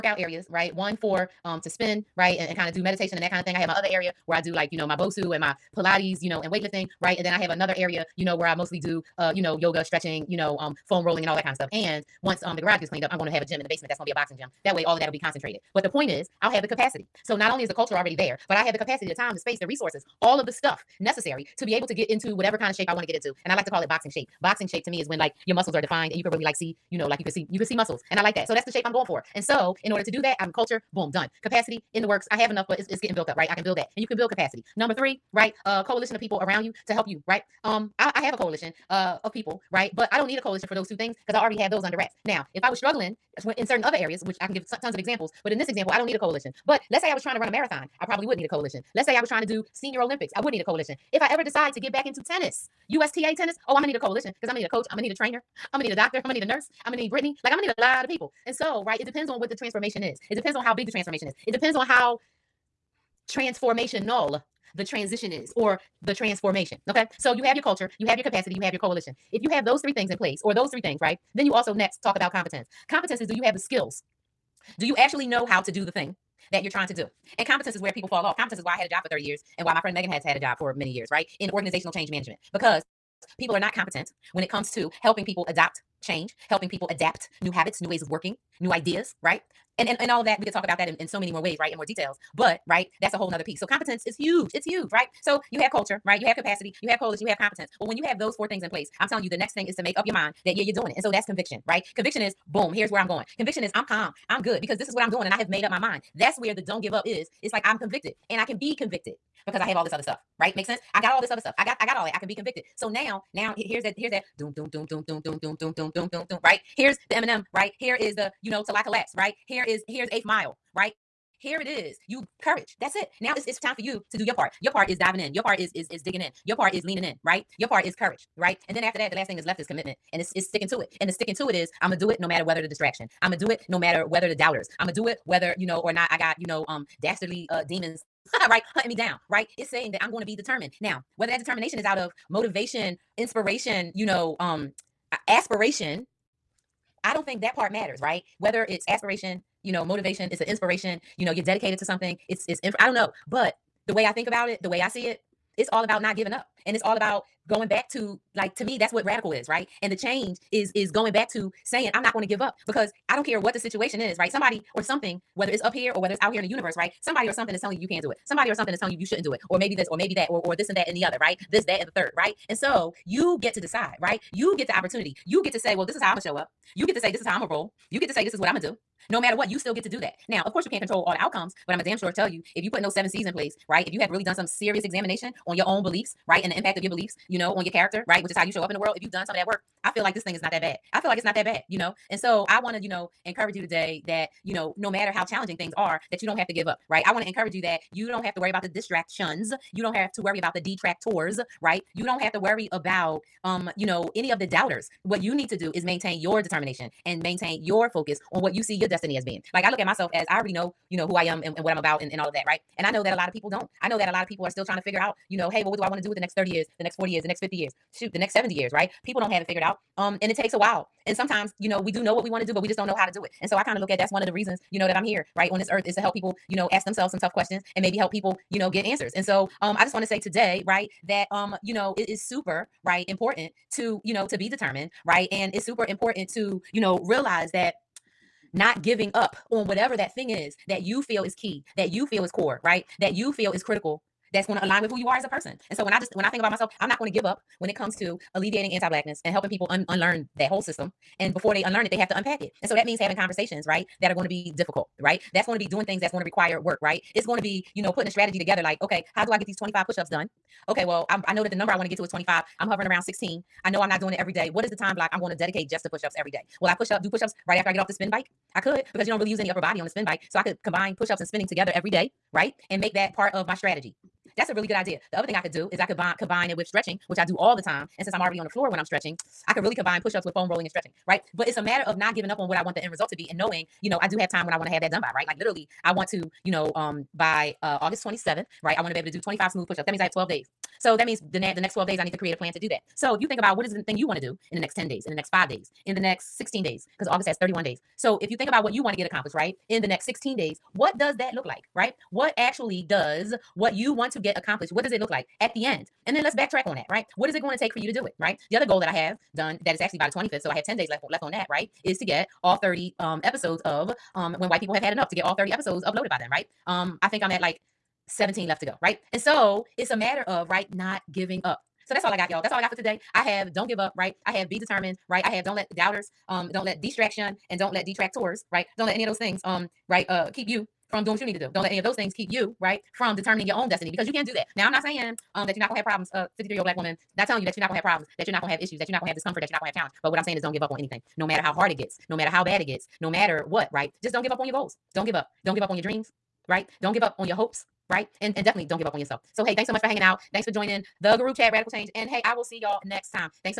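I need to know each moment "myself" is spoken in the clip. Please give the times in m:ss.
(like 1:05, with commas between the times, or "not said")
3:29, 4:06.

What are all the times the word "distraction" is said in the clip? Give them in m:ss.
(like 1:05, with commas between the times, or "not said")
2:12, 3:18, 5:26.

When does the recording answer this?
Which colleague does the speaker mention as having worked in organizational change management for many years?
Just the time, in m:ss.
1:19.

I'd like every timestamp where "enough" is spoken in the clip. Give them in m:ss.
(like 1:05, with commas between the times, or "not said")
0:32, 5:14.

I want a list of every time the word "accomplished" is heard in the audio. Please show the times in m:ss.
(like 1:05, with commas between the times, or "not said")
4:59, 5:04.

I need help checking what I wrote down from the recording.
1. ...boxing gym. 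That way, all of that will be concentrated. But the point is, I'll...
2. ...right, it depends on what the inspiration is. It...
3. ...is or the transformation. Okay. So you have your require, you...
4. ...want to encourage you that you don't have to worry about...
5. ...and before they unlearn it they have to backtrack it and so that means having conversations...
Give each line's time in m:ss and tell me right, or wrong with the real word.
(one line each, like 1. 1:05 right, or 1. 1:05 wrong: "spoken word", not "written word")
1. 0:14 right
2. 0:58 wrong: "transformation", not "inspiration"
3. 1:05 wrong: "culture", not "require"
4. 3:17 right
5. 4:11 wrong: "unpack", not "backtrack".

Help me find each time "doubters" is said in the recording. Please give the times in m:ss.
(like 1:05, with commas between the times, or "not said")
2:14, 3:24, 5:25.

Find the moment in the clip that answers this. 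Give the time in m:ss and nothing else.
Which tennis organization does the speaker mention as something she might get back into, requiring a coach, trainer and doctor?
0:52.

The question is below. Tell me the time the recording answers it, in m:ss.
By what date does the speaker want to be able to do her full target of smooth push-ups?
4:47.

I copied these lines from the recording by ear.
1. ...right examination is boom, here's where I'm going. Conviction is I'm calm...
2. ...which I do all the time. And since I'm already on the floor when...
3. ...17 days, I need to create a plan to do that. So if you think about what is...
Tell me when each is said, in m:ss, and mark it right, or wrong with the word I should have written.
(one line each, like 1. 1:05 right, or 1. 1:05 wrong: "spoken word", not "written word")
1. 1:41 wrong: "conviction", not "examination"
2. 4:37 right
3. 4:51 wrong: "12", not "17".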